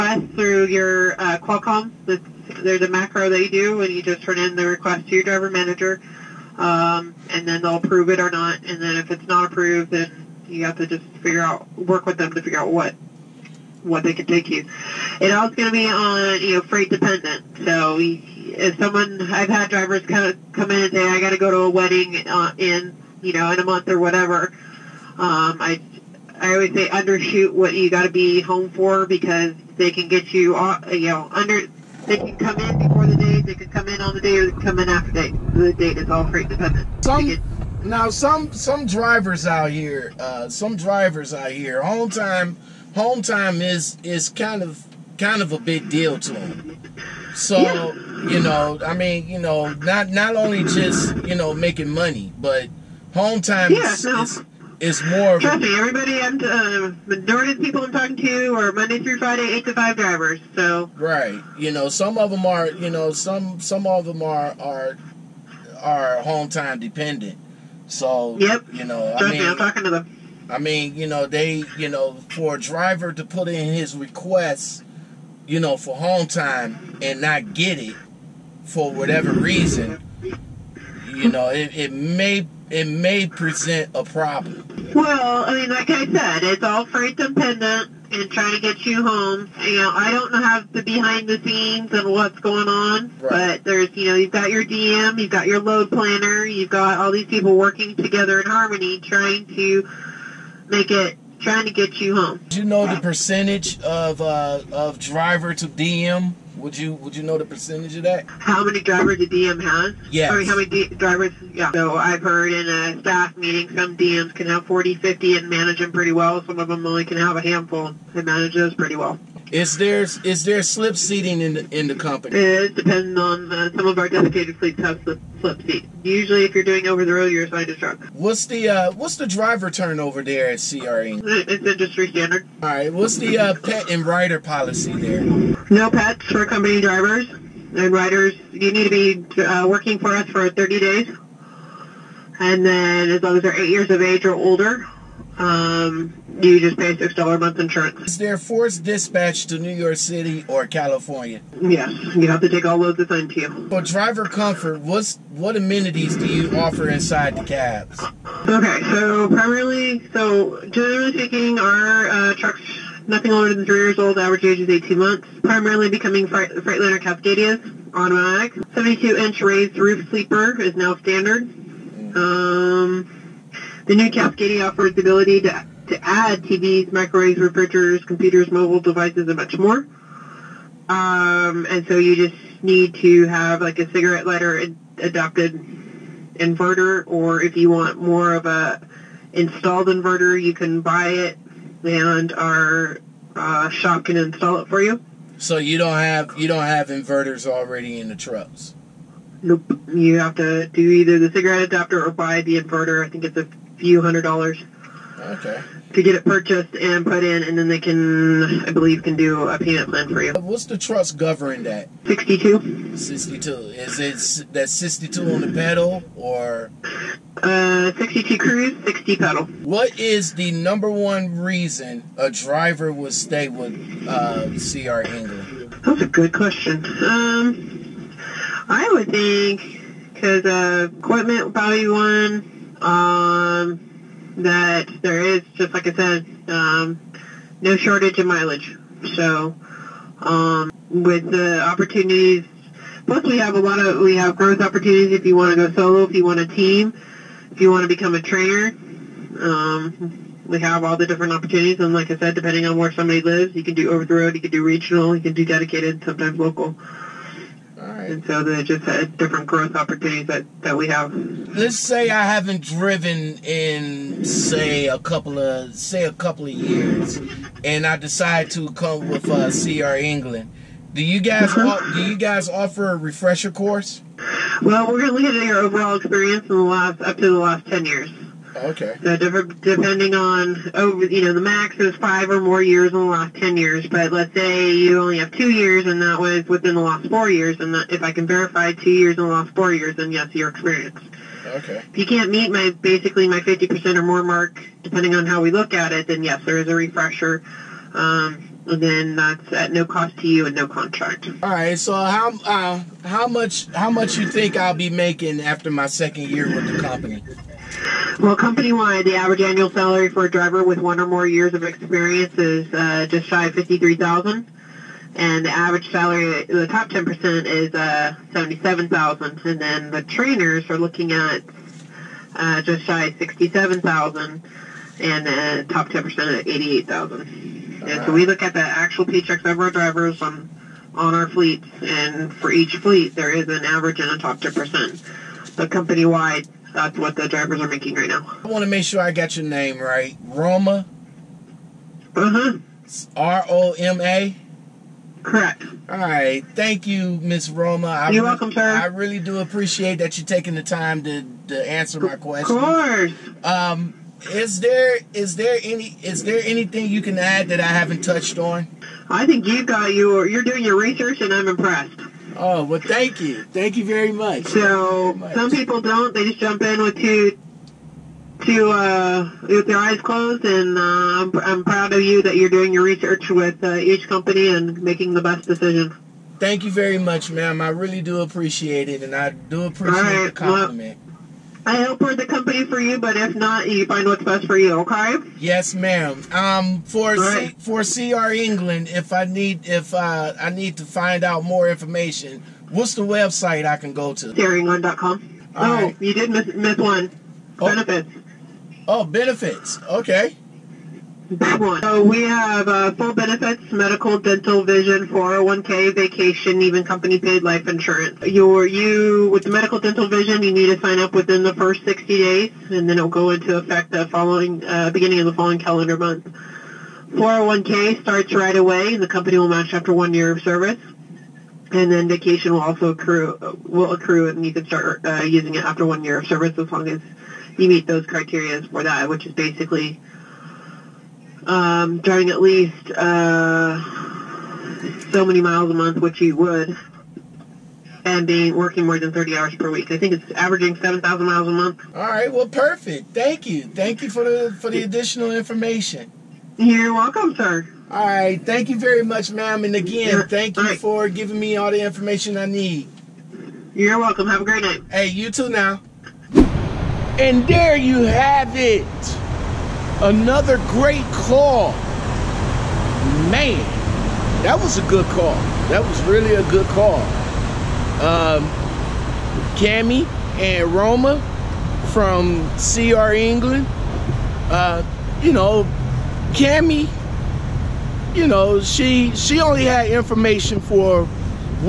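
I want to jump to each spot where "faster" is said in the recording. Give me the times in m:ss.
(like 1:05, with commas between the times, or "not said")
not said.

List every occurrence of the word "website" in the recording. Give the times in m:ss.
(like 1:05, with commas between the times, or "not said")
6:33.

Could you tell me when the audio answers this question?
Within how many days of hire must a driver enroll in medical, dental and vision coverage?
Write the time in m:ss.
6:51.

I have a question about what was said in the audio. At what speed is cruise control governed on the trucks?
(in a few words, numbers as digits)
62.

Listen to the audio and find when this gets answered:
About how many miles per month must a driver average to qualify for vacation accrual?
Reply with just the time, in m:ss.
7:20.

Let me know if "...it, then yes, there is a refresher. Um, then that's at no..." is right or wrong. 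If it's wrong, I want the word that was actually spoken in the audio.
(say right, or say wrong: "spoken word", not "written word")
right.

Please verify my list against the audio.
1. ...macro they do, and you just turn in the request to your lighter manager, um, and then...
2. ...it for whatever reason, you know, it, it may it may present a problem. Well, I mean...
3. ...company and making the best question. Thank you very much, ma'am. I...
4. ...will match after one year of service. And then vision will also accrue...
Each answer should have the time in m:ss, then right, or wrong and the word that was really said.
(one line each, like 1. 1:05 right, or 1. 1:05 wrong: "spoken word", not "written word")
1. 0:02 wrong: "driver", not "lighter"
2. 1:17 right
3. 6:14 wrong: "decision", not "question"
4. 6:59 wrong: "vacation", not "vision".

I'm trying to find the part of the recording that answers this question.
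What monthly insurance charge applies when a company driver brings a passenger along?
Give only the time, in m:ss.
2:26.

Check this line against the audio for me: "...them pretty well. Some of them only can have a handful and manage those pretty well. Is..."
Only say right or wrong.
right.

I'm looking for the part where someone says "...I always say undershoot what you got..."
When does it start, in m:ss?
0:26.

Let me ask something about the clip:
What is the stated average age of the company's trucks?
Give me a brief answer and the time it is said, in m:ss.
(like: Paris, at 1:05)
18 months, at 2:44.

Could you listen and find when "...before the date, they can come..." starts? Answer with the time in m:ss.
0:32.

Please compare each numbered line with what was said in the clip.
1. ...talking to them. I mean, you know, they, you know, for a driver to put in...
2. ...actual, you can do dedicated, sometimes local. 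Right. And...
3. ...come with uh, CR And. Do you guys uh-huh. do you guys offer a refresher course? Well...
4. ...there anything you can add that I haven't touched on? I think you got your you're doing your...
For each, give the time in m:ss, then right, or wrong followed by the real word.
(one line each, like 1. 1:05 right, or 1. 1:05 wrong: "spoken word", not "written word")
1. 1:09 right
2. 4:14 wrong: "regional", not "actual"
3. 4:28 wrong: "England", not "And"
4. 5:56 right.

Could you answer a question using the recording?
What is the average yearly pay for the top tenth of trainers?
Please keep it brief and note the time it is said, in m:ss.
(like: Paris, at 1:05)
$88,000, at 5:26.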